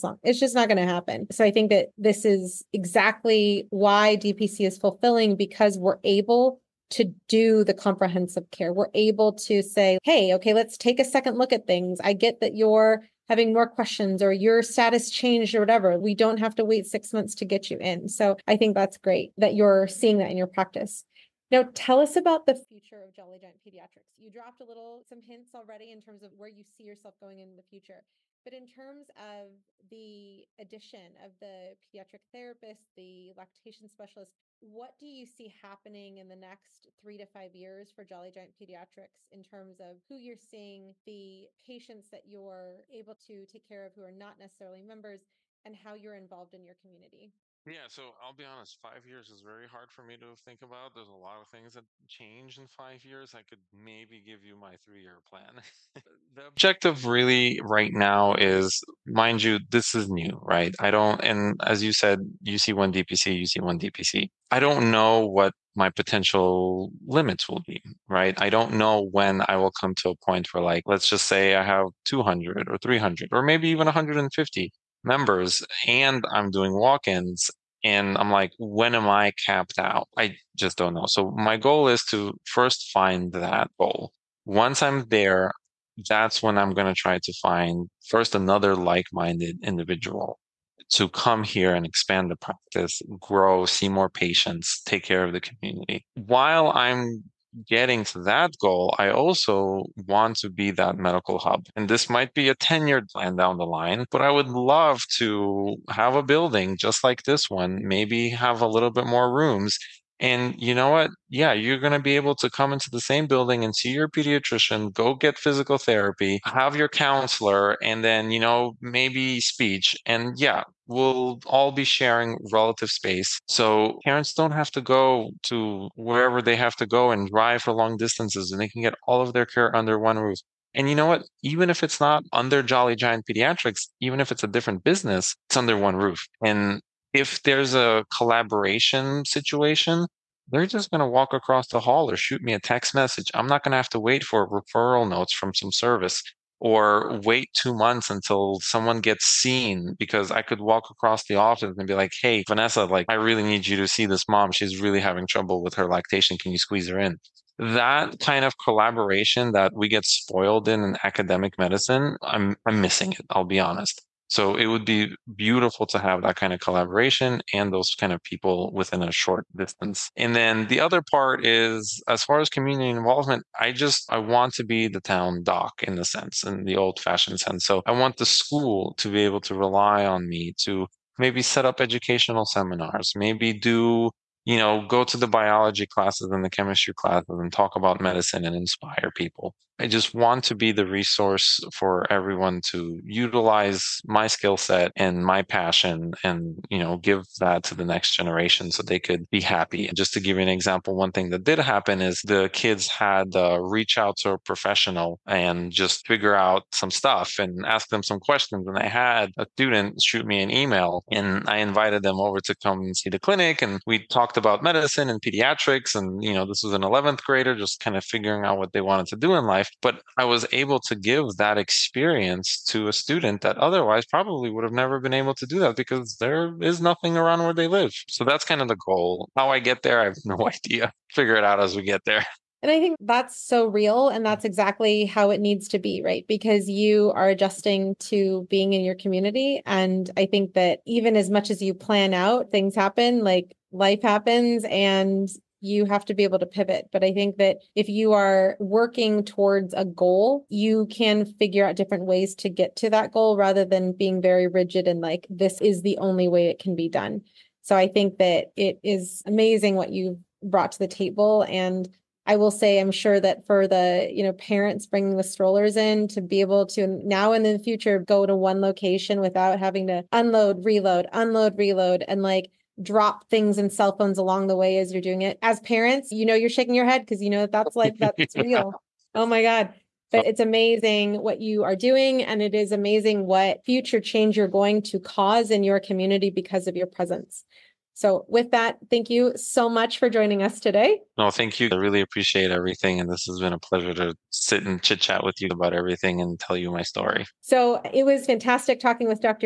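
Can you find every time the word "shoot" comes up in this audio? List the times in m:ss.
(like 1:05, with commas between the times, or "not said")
2:22, 3:30.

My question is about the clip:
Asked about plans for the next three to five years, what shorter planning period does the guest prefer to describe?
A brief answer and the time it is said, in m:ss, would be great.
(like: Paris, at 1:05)
3 year plan, at 0:54.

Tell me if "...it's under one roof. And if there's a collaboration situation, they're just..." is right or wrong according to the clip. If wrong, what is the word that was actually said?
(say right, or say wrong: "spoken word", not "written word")
right.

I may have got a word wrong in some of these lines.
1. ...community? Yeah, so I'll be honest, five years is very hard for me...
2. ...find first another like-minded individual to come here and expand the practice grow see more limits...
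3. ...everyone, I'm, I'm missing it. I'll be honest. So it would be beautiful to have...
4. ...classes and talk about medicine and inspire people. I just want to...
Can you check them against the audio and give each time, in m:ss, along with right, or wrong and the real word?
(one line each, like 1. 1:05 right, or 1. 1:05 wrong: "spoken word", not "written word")
1. 0:46 right
2. 1:27 wrong: "patients", not "limits"
3. 2:41 wrong: "medicine", not "everyone"
4. 3:06 right.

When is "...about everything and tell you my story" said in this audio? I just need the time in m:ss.
4:55.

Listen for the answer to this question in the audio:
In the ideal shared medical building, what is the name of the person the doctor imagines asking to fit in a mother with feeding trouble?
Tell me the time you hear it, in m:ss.
2:32.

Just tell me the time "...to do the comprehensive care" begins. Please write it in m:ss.
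0:06.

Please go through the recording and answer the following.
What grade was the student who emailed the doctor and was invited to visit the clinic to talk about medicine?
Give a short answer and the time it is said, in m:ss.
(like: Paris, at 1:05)
11th grade, at 3:36.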